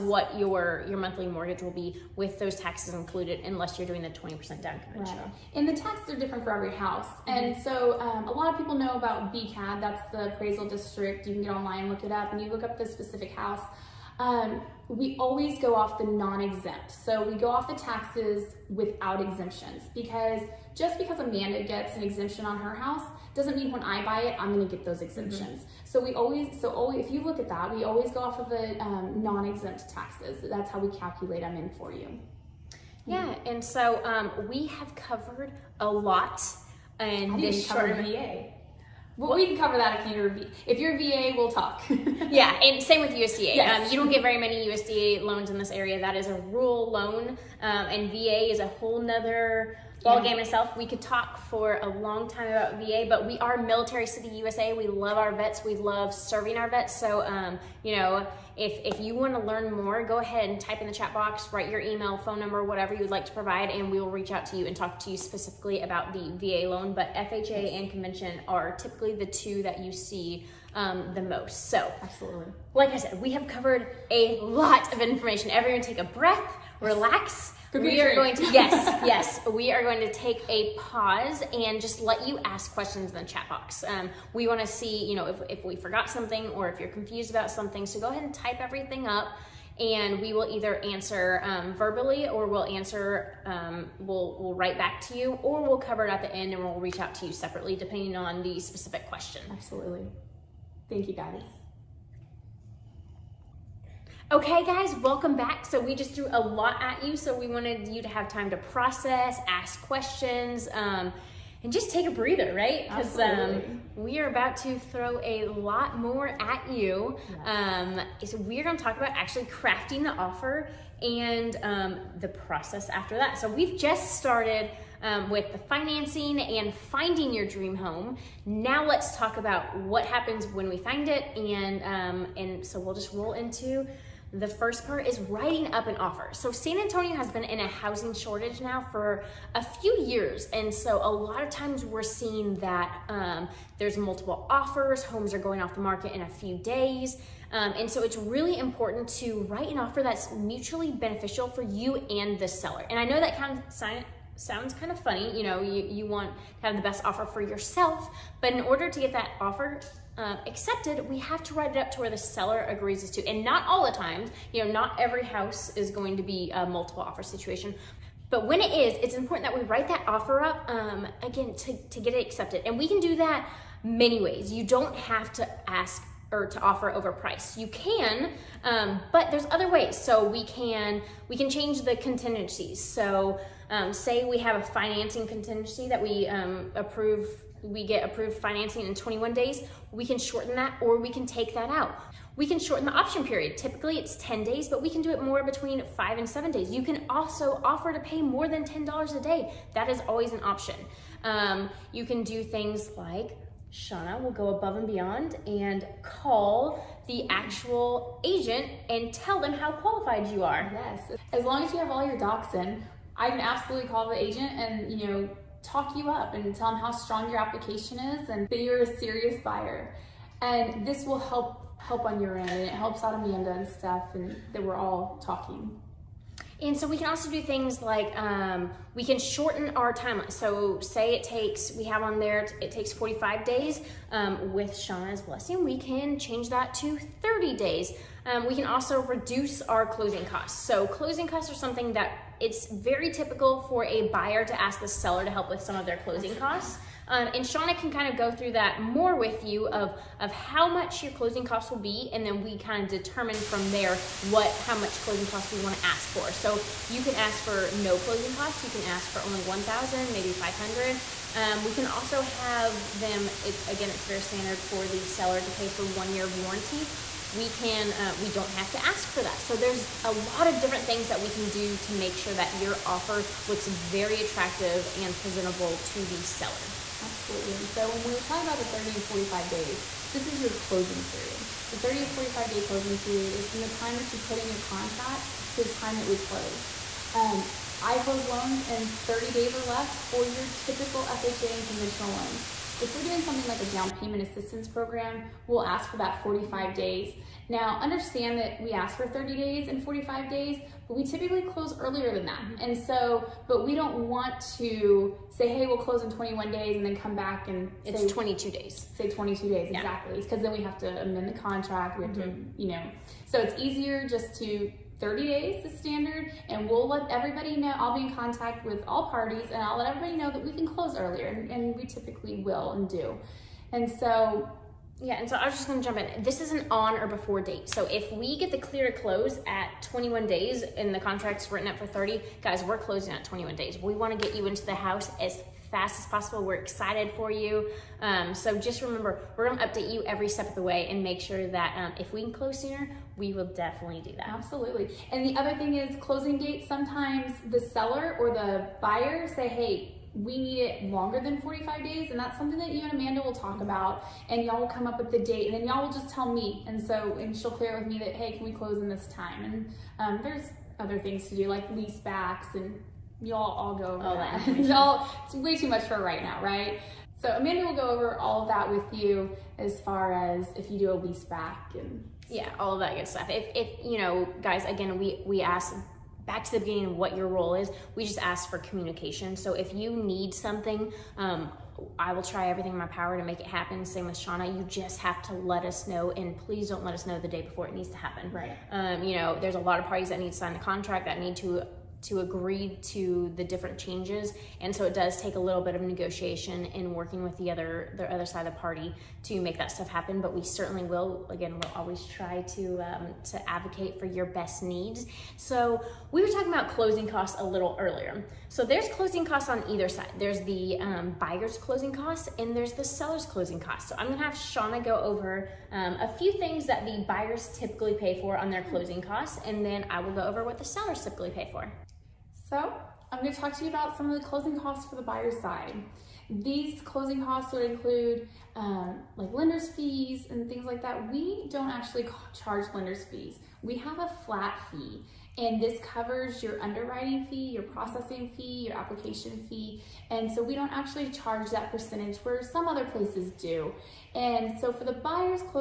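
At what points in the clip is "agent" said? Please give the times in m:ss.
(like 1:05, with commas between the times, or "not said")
3:28, 3:34.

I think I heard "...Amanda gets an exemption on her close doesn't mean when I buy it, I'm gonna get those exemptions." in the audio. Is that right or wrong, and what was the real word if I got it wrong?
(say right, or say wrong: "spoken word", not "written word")
wrong: "house", not "close".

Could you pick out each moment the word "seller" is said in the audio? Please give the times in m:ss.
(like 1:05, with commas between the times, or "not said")
2:32, 2:42, 4:04, 4:25, 4:36, 5:47, 6:52, 7:00.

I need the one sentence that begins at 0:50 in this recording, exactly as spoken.
We could talk for a long time about VA, but we are military city USA.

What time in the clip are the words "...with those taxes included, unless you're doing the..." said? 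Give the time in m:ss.
0:02.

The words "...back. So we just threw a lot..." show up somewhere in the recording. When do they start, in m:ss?
1:45.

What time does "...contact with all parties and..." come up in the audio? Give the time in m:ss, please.
5:18.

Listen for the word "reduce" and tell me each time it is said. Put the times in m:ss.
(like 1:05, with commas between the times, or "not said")
3:59.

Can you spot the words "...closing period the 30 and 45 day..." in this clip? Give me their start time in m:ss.
4:40.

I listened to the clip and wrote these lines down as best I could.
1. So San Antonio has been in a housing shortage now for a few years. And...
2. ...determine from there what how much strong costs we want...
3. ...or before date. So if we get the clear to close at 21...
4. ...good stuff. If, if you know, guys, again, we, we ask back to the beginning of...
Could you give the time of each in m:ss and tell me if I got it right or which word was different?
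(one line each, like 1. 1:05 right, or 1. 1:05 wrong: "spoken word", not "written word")
1. 2:16 right
2. 4:12 wrong: "closing", not "strong"
3. 5:26 right
4. 6:12 right.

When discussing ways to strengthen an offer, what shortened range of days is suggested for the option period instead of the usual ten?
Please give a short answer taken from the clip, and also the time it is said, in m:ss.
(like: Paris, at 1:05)
5 to 7 days, at 3:15.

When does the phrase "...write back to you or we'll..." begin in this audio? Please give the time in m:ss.
1:34.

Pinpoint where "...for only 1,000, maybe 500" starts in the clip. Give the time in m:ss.
4:19.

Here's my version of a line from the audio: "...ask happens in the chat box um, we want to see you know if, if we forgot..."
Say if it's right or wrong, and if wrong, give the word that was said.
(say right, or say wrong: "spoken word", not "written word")
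wrong: "questions", not "happens".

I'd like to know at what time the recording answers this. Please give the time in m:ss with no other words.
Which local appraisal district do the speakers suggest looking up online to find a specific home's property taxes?
0:09.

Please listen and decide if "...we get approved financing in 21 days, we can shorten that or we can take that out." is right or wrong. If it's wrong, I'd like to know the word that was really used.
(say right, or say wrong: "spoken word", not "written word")
right.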